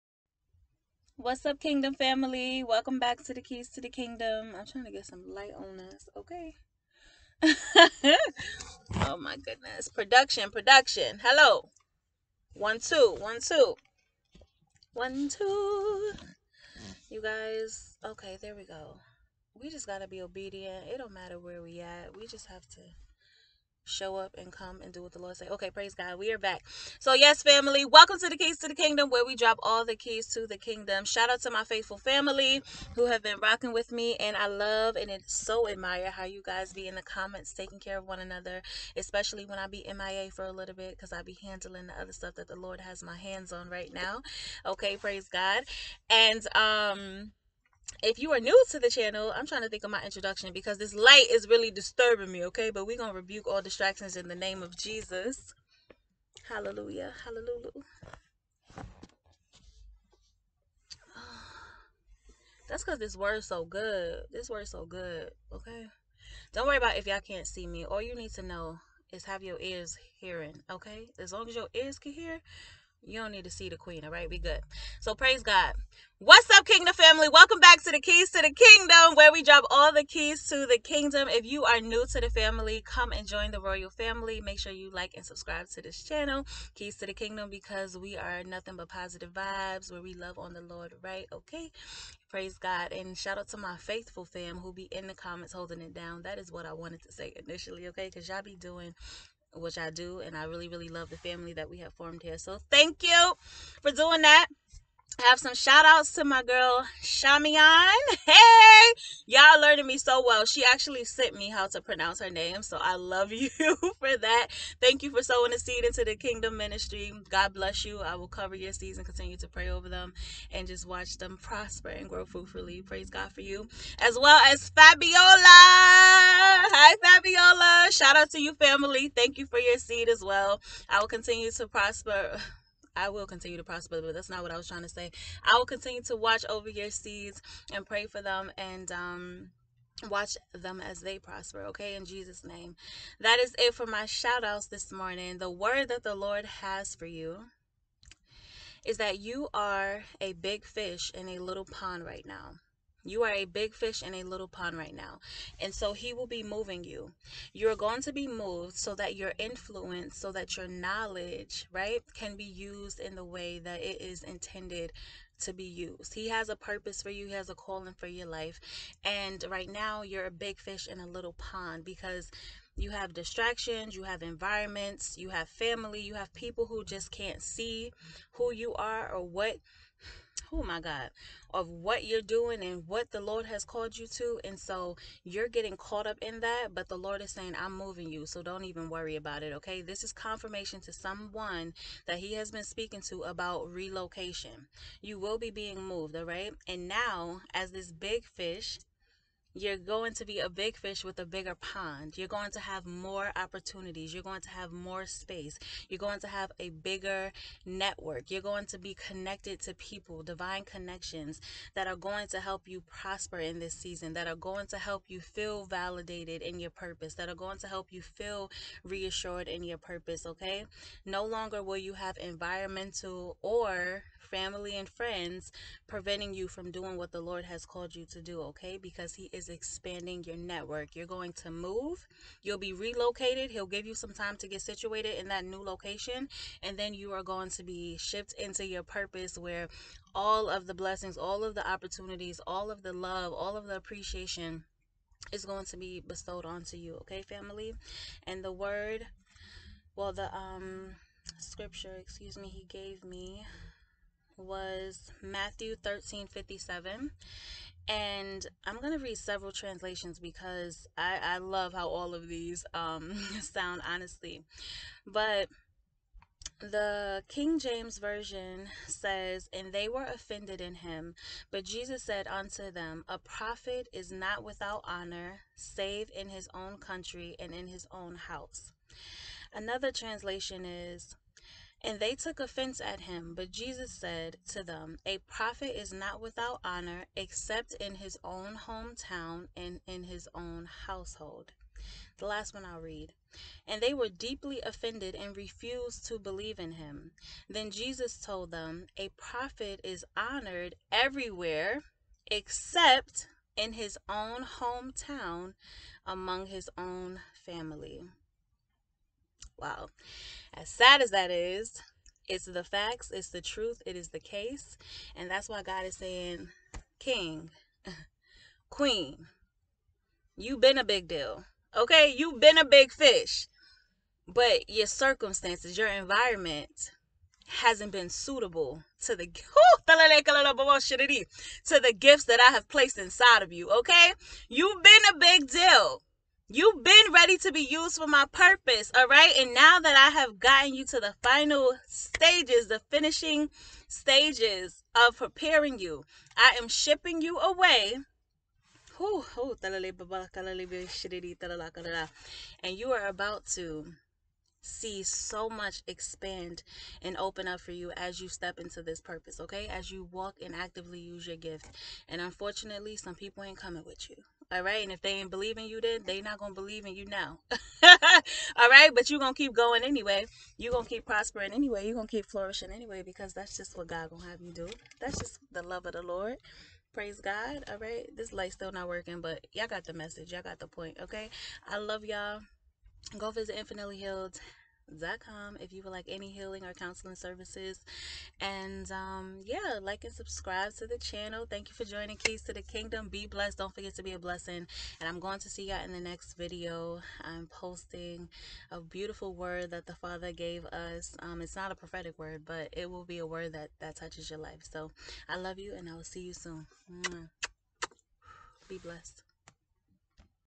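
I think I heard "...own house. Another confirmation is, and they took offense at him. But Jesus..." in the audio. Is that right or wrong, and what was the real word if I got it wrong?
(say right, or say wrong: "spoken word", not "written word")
wrong: "translation", not "confirmation".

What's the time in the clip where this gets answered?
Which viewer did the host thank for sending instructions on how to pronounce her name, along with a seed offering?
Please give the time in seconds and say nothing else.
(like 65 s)
107 s.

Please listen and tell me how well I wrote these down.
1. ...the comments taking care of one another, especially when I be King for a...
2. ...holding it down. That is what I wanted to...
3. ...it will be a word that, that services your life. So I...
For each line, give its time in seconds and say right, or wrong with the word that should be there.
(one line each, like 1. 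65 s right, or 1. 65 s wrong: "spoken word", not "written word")
1. 36 s wrong: "MIA", not "King"
2. 95 s right
3. 402 s wrong: "touches", not "services".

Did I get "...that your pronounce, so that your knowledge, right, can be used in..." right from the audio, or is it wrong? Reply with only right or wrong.
wrong.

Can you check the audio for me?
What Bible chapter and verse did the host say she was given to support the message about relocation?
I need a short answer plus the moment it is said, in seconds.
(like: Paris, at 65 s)
Matthew 13:57, at 255 s.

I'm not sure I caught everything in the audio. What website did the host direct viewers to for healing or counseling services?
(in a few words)
Infinitely Healed.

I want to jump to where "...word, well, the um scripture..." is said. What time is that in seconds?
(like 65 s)
248 s.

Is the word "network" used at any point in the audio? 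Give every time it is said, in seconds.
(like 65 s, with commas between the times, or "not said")
207 s, 230 s.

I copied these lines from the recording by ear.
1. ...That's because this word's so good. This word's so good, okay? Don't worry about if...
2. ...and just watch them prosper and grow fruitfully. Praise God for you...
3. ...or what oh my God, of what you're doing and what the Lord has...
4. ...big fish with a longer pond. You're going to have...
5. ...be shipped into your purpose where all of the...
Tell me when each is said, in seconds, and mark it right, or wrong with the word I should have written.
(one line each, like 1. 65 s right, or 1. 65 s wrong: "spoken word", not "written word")
1. 62 s right
2. 120 s right
3. 179 s right
4. 200 s wrong: "bigger", not "longer"
5. 237 s right.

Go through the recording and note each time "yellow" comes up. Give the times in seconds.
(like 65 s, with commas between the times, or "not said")
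not said.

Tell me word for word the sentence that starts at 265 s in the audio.
But the King James Version says, And they were offended in him.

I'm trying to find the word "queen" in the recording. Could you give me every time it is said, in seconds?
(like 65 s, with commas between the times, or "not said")
73 s, 318 s.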